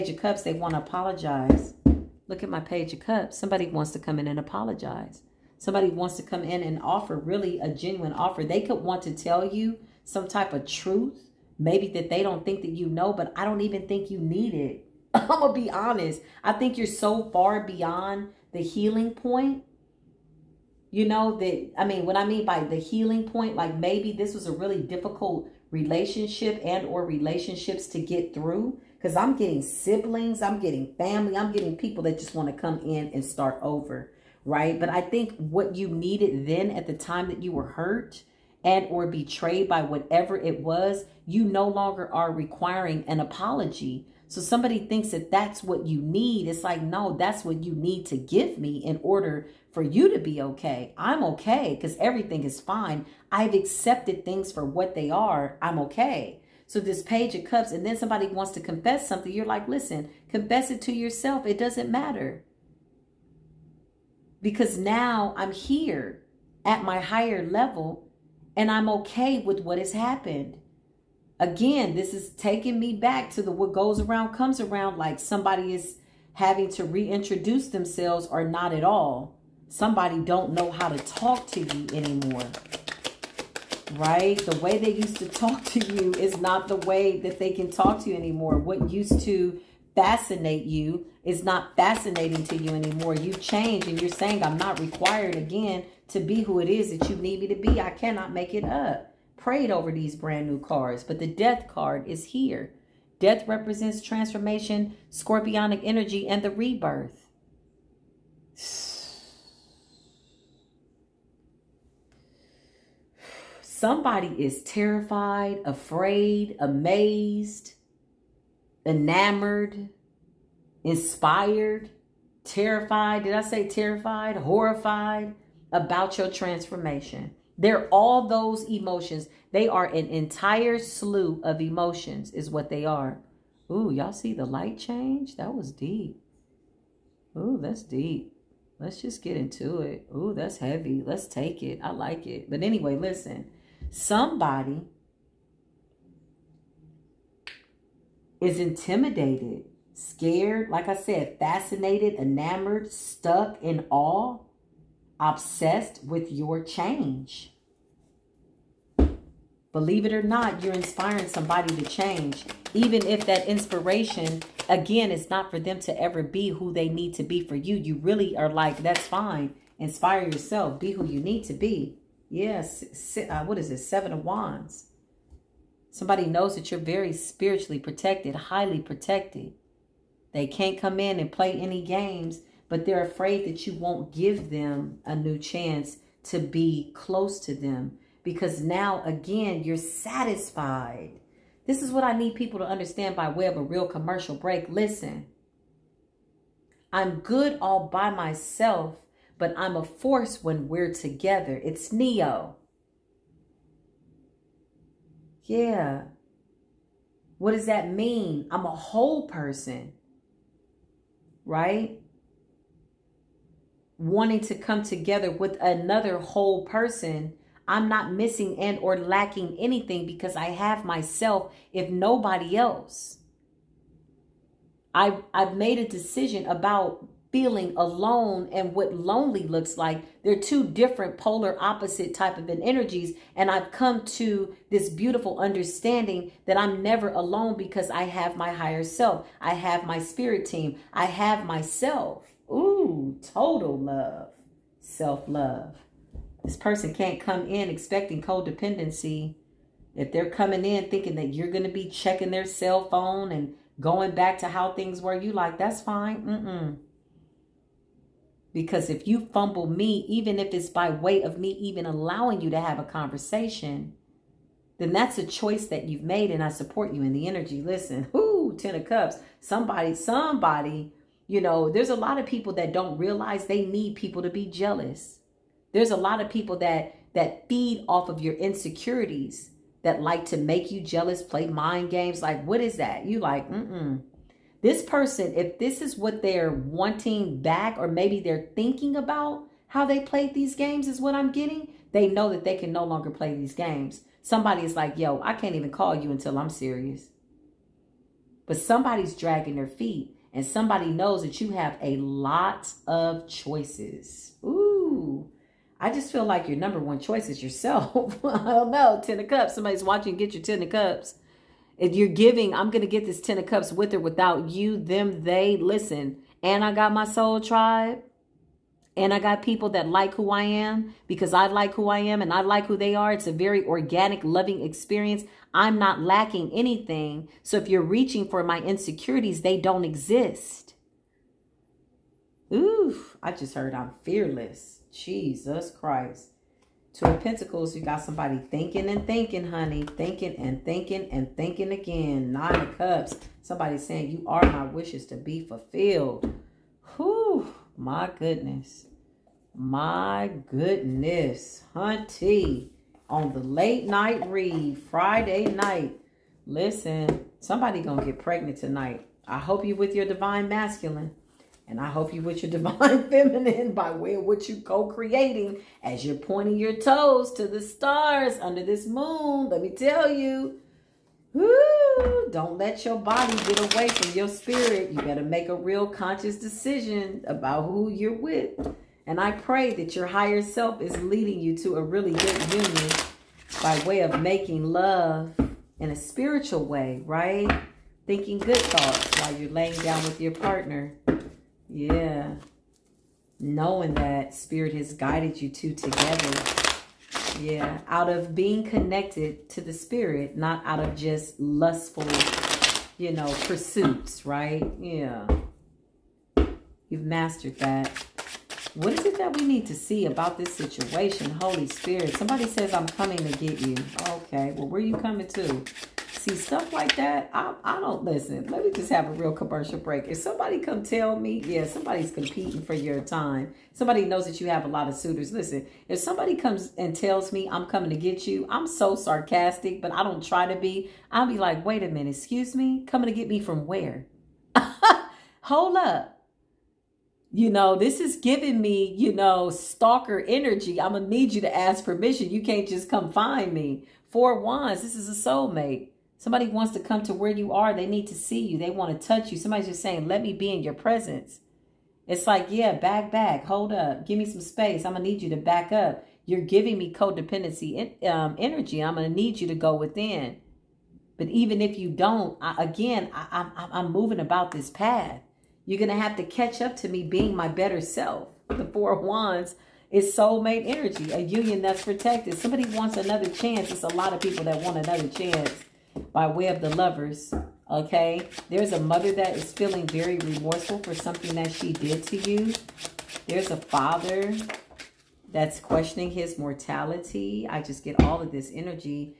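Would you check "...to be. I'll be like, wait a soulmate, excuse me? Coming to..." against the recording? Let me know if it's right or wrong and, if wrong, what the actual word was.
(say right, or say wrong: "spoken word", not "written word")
wrong: "minute", not "soulmate".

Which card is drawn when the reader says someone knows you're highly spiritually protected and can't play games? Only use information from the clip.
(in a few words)
Seven of Wands.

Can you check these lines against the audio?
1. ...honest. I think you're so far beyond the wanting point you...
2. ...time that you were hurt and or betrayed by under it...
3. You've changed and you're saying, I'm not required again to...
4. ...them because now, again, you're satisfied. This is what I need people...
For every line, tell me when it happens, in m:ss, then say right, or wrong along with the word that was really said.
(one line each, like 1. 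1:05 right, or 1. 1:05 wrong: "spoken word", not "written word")
1. 0:15 wrong: "healing", not "wanting"
2. 0:36 wrong: "whatever", not "under"
3. 1:33 right
4. 3:07 right.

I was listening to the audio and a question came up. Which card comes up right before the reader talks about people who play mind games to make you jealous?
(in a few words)
Ten of Cups.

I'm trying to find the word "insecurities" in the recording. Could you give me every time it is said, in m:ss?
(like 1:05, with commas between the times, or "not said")
4:38, 5:28.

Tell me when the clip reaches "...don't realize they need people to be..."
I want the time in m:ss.
4:32.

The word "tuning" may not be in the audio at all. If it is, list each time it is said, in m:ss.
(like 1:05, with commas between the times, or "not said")
not said.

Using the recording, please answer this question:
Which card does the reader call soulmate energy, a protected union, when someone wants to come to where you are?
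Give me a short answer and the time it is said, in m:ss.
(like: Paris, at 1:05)
Four of Wands, at 7:24.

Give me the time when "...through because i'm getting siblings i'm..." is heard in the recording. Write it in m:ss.
0:28.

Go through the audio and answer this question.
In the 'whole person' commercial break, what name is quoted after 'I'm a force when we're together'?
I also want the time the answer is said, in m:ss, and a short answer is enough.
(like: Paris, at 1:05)
Neo, at 3:21.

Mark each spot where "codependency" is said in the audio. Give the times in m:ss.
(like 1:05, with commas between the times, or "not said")
4:08, 7:36.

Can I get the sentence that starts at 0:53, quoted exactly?
I've accepted things for what they are.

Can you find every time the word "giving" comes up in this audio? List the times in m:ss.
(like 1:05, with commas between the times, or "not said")
5:12, 7:18, 7:36.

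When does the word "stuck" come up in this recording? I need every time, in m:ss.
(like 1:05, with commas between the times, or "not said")
2:32.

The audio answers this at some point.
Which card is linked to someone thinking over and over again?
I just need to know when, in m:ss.
5:36.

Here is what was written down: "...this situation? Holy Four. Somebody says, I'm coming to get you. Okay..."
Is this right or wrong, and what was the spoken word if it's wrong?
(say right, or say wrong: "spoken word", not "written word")
wrong: "Spirit", not "Four".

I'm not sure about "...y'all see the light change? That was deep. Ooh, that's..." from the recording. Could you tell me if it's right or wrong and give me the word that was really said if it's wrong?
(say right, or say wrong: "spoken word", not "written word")
right.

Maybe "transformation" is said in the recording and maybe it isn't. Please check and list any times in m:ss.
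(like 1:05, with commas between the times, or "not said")
1:43, 2:06.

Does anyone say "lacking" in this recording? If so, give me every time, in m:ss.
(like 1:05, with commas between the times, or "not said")
3:38, 5:25.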